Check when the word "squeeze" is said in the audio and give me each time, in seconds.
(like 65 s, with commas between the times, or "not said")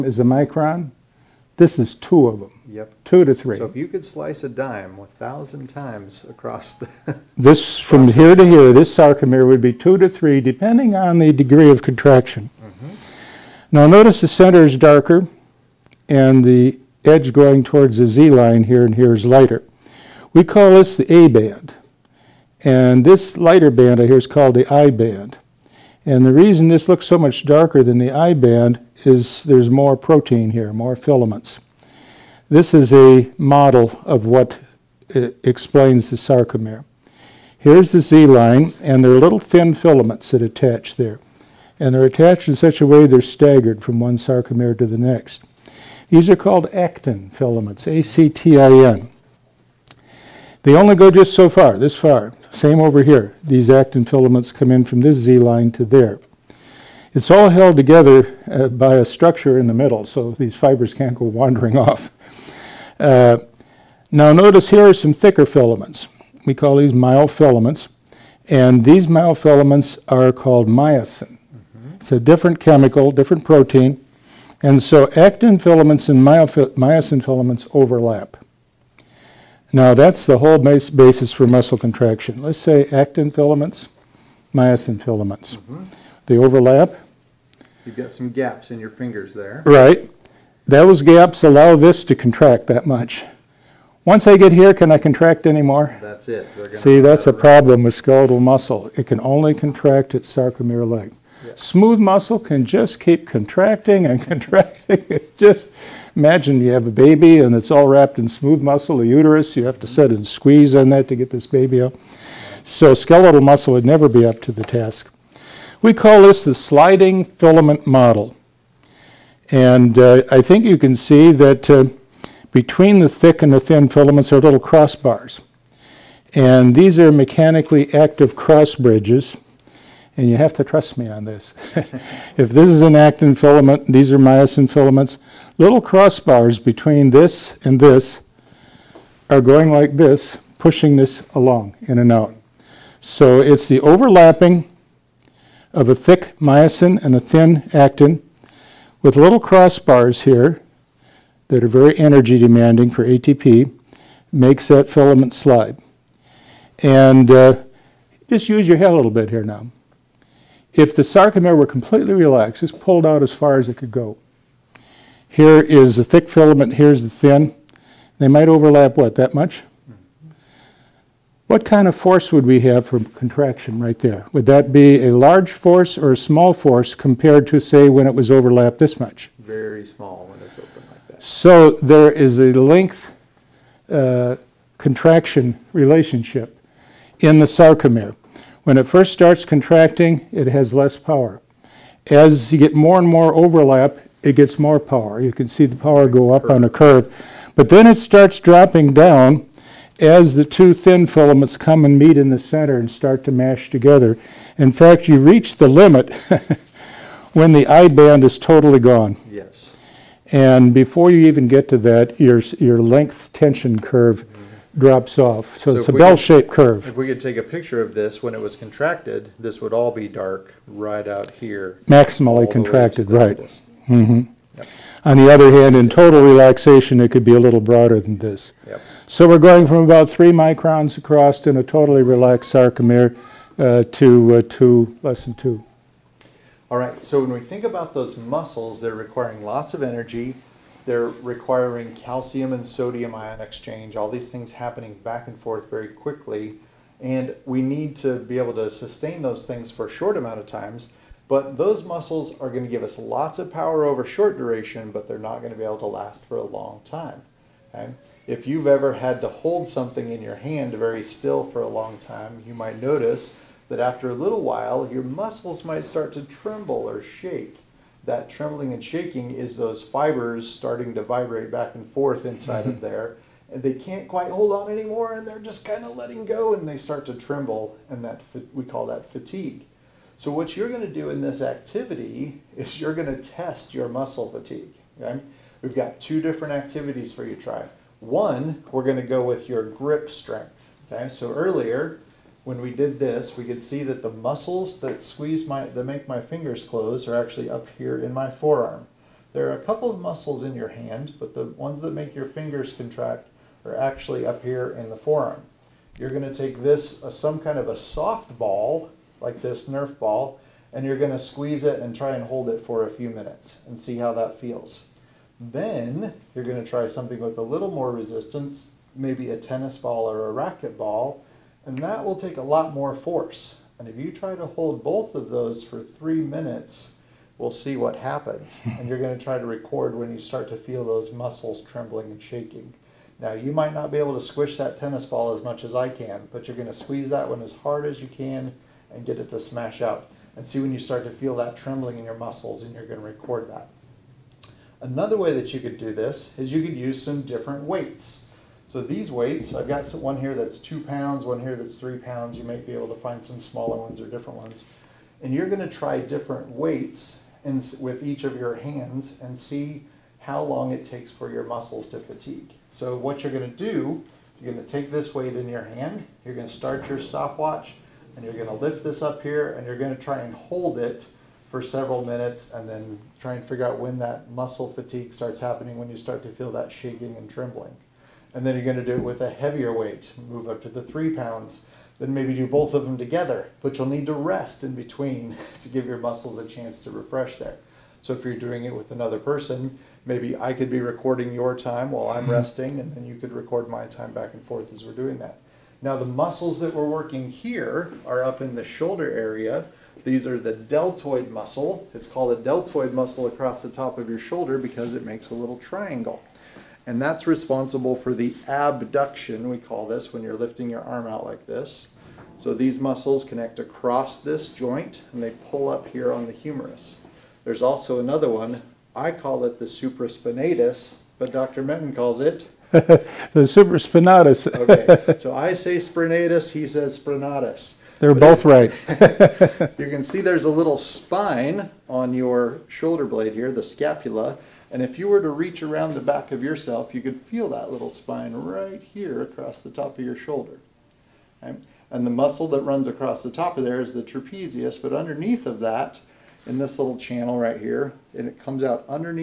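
110 s, 295 s, 311 s, 336 s.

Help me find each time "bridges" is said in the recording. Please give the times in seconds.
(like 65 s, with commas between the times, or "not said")
128 s.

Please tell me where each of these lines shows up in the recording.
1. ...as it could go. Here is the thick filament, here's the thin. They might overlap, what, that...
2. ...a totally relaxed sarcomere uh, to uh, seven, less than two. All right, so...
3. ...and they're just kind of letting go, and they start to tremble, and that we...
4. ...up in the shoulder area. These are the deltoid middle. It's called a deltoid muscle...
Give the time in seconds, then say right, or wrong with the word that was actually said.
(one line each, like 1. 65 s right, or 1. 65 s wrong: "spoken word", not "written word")
1. 163 s right
2. 231 s wrong: "two", not "seven"
3. 275 s right
4. 398 s wrong: "muscle", not "middle".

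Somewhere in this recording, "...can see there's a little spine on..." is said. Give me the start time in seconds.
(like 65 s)
429 s.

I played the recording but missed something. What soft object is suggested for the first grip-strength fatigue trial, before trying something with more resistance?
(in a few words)
Nerf ball.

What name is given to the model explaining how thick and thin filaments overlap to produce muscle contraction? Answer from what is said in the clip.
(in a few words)
sliding filament model.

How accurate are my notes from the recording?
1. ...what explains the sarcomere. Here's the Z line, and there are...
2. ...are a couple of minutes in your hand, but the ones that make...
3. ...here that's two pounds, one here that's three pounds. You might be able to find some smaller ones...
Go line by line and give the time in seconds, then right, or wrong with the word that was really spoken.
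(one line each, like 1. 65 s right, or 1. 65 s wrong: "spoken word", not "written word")
1. 34 s right
2. 299 s wrong: "muscles", not "minutes"
3. 350 s right.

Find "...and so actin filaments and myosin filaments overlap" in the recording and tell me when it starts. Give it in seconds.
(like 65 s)
74 s.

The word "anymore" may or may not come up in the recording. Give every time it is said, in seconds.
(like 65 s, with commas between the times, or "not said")
95 s, 274 s.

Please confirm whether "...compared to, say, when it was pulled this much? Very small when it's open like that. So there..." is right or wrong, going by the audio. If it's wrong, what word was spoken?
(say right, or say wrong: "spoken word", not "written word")
wrong: "overlapped", not "pulled".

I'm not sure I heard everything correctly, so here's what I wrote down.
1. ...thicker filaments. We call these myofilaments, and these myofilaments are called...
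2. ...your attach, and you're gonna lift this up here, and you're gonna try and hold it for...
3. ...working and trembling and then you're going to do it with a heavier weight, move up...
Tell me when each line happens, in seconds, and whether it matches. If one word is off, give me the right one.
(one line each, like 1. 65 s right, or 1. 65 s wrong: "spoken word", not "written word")
1. 65 s right
2. 366 s wrong: "stopwatch", not "attach"
3. 376 s wrong: "shaking", not "working".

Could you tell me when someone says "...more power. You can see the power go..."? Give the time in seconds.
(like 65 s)
194 s.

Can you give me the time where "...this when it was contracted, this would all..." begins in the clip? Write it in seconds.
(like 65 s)
217 s.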